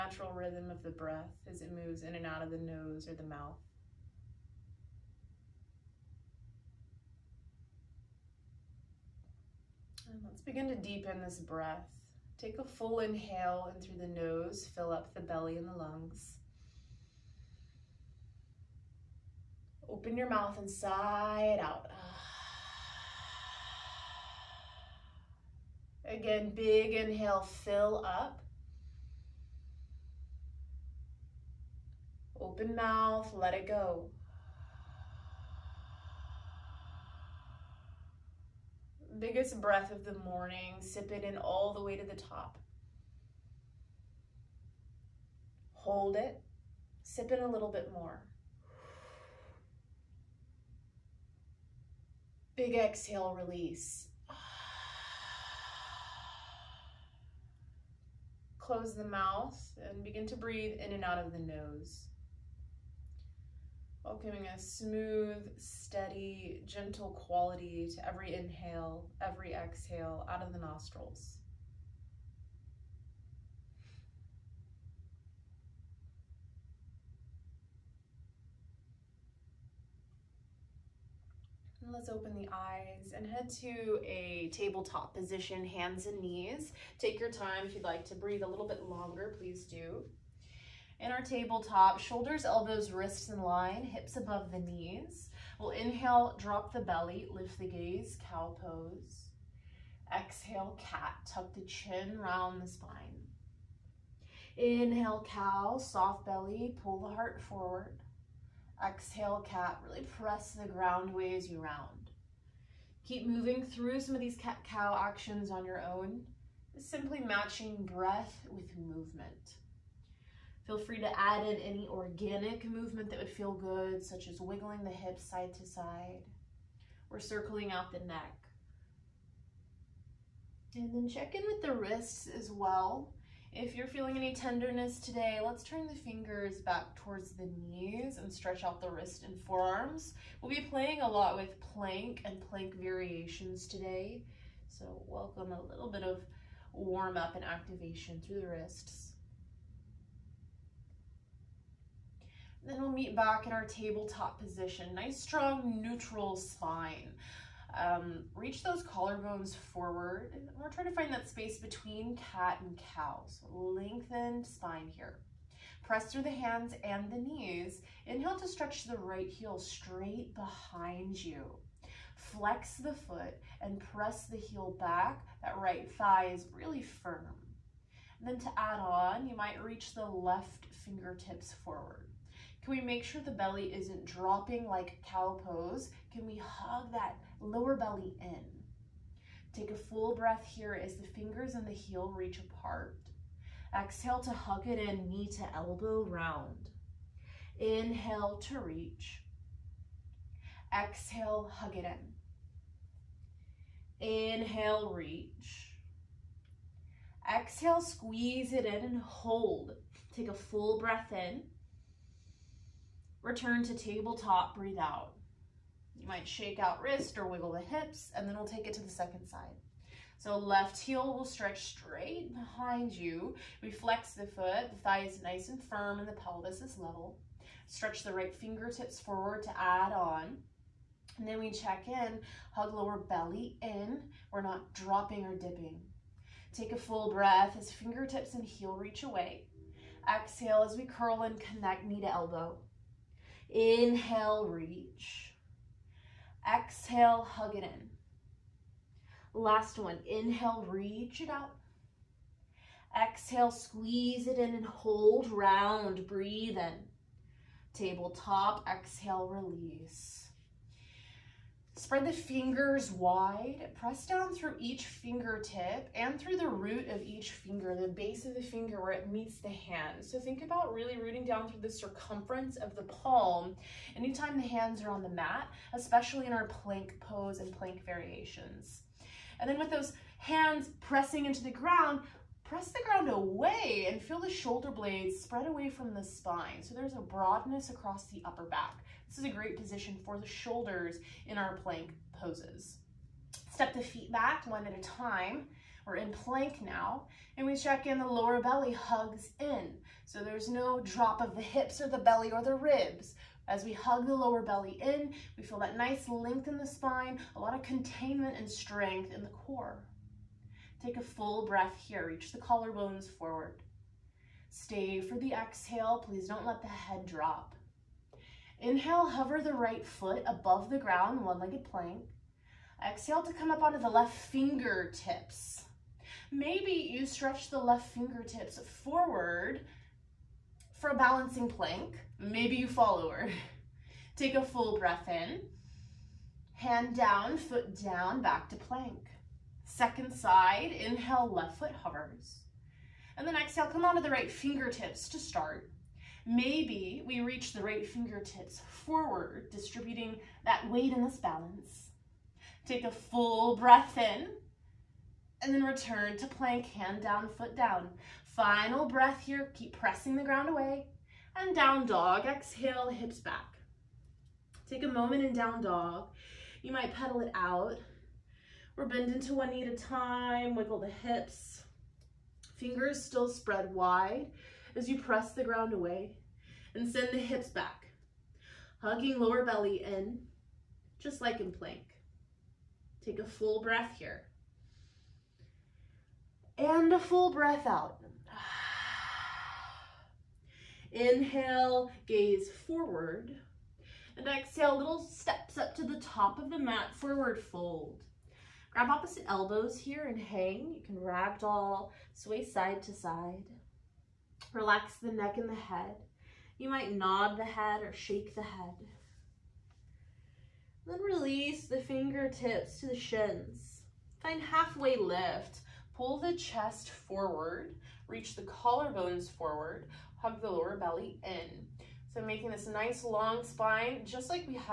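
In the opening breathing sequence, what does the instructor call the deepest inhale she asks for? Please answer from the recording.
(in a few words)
Biggest breath of the morning.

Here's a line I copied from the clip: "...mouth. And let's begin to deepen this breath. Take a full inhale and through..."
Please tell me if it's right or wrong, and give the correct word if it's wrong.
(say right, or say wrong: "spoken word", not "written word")
right.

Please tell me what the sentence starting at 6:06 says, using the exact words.
You might pedal it out, we're bending to one knee at a time, wiggle the hips.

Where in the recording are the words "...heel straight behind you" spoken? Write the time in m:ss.
2:49.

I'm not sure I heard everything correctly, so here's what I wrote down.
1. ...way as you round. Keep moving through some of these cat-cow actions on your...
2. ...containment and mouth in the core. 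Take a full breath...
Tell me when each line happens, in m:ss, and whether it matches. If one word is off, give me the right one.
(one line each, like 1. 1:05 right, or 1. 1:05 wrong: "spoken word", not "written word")
1. 1:51 right
2. 5:07 wrong: "strength", not "mouth".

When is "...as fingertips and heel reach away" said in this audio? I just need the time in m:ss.
3:57.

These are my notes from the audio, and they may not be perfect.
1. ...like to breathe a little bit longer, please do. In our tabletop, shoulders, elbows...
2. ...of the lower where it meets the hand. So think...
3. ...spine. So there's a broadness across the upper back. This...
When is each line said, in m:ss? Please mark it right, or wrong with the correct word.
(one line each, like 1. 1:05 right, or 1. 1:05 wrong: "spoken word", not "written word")
1. 1:27 right
2. 4:28 wrong: "finger", not "lower"
3. 4:46 right.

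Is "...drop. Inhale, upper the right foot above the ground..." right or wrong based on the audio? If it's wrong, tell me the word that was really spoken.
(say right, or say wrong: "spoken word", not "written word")
wrong: "hover", not "upper".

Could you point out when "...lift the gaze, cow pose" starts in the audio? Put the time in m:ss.
1:37.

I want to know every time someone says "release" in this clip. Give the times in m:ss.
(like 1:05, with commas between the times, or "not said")
0:53, 4:19, 6:51.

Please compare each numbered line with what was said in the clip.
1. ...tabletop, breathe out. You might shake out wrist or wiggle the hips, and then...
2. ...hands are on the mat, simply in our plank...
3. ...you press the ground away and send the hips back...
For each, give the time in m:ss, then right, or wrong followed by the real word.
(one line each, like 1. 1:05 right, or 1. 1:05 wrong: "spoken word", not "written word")
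1. 3:33 right
2. 4:34 wrong: "especially", not "simply"
3. 6:14 right.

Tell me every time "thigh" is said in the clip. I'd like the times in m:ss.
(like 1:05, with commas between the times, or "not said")
2:55, 3:44.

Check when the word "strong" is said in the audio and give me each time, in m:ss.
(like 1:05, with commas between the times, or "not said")
2:35.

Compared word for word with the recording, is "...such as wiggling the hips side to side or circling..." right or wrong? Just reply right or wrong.
right.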